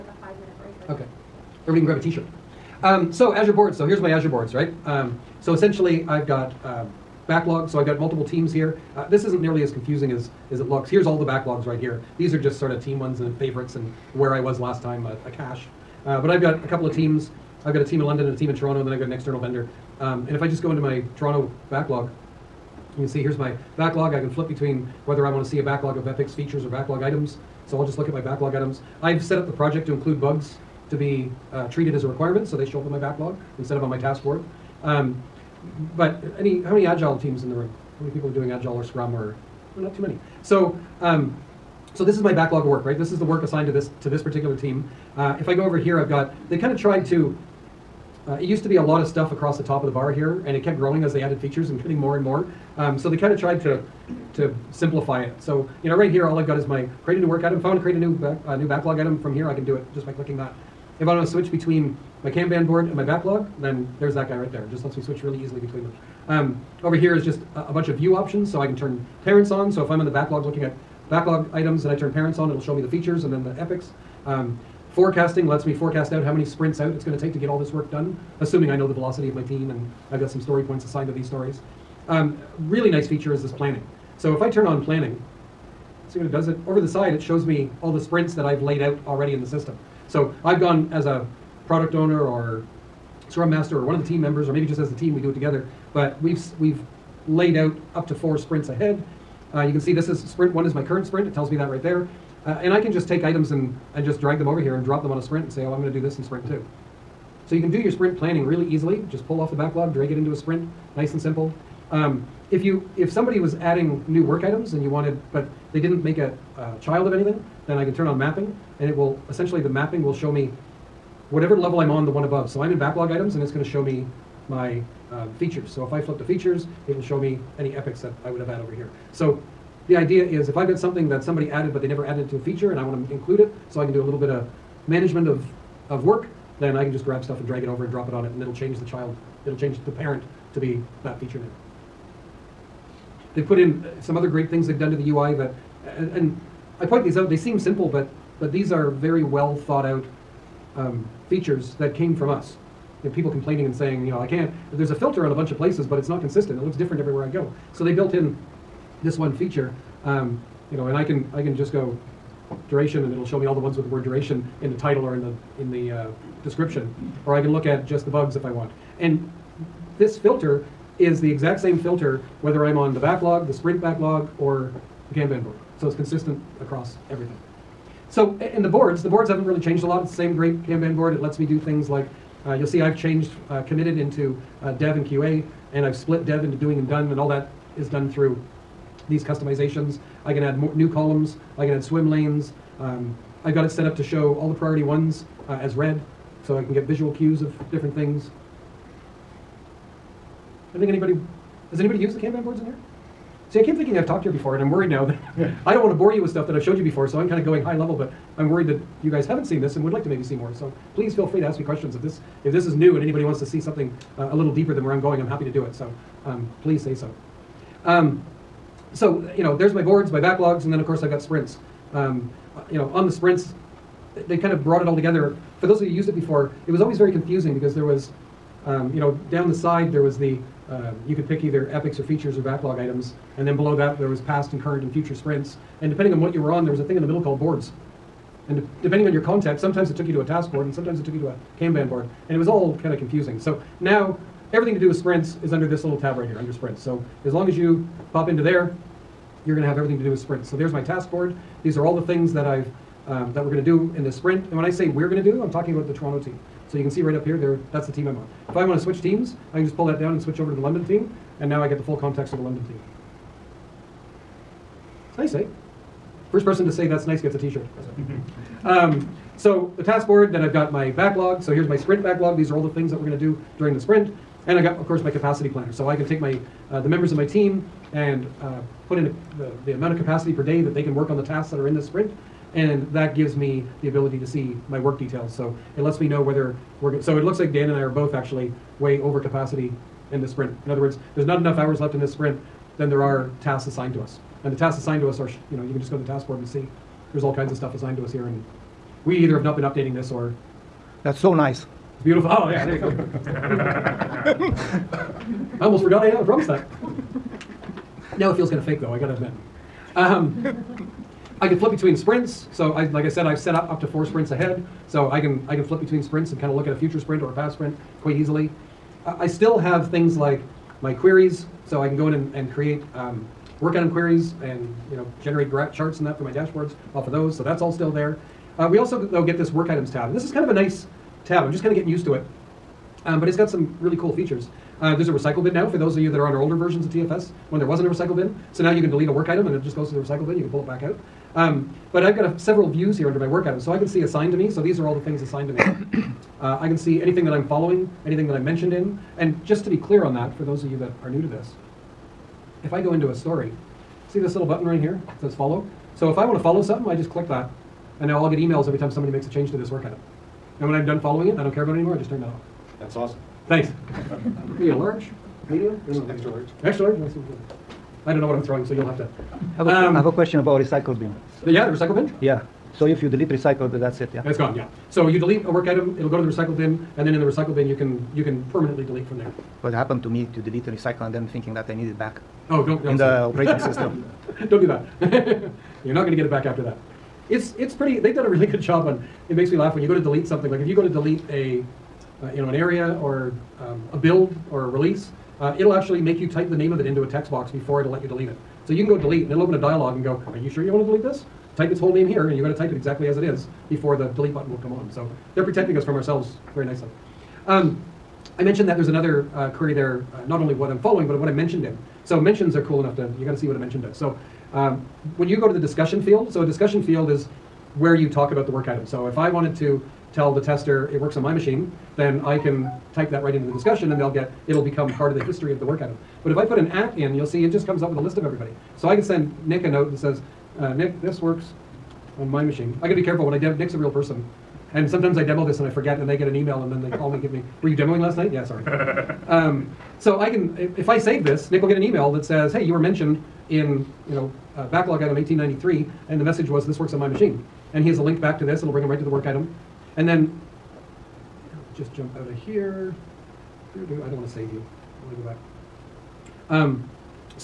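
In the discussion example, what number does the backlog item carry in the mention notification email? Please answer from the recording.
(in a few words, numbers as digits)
1893.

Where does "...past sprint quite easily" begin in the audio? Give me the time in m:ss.
5:17.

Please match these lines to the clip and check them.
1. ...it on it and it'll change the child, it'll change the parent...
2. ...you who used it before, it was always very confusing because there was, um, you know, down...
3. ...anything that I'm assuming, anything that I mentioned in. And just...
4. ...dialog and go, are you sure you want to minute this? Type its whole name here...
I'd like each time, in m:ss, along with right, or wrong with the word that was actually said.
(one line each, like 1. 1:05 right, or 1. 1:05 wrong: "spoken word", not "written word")
1. 2:18 right
2. 3:45 right
3. 5:47 wrong: "following", not "assuming"
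4. 6:39 wrong: "delete", not "minute".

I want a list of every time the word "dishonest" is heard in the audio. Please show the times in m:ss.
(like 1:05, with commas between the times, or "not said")
not said.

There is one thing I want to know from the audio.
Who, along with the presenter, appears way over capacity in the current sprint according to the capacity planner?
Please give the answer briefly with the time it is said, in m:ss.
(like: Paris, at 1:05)
Dan, at 4:47.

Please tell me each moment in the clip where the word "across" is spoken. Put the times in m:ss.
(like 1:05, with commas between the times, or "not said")
0:49, 2:56.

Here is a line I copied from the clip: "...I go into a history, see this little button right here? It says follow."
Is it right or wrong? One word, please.
wrong.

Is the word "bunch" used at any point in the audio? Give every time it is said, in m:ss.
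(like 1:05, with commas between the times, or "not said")
1:07, 2:35.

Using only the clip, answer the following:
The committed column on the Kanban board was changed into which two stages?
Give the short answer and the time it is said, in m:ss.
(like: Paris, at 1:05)
dev and QA, at 3:04.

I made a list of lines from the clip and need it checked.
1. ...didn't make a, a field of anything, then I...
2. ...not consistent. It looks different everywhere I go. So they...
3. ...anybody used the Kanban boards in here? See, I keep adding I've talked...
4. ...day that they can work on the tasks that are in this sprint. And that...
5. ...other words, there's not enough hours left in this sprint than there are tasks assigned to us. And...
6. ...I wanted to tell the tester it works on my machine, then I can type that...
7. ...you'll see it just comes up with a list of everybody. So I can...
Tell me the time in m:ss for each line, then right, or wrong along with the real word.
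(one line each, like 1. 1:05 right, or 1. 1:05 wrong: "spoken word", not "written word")
1. 1:55 wrong: "child", not "field"
2. 2:36 right
3. 3:21 wrong: "thinking", not "adding"
4. 4:40 right
5. 4:50 right
6. 6:59 right
7. 7:07 right.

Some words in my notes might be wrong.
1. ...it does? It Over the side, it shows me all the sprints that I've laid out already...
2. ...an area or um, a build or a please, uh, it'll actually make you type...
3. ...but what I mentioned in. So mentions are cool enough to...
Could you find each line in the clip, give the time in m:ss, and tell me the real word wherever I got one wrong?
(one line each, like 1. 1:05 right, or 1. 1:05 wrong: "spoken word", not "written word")
1. 1:26 right
2. 6:32 wrong: "release", not "please"
3. 6:51 right.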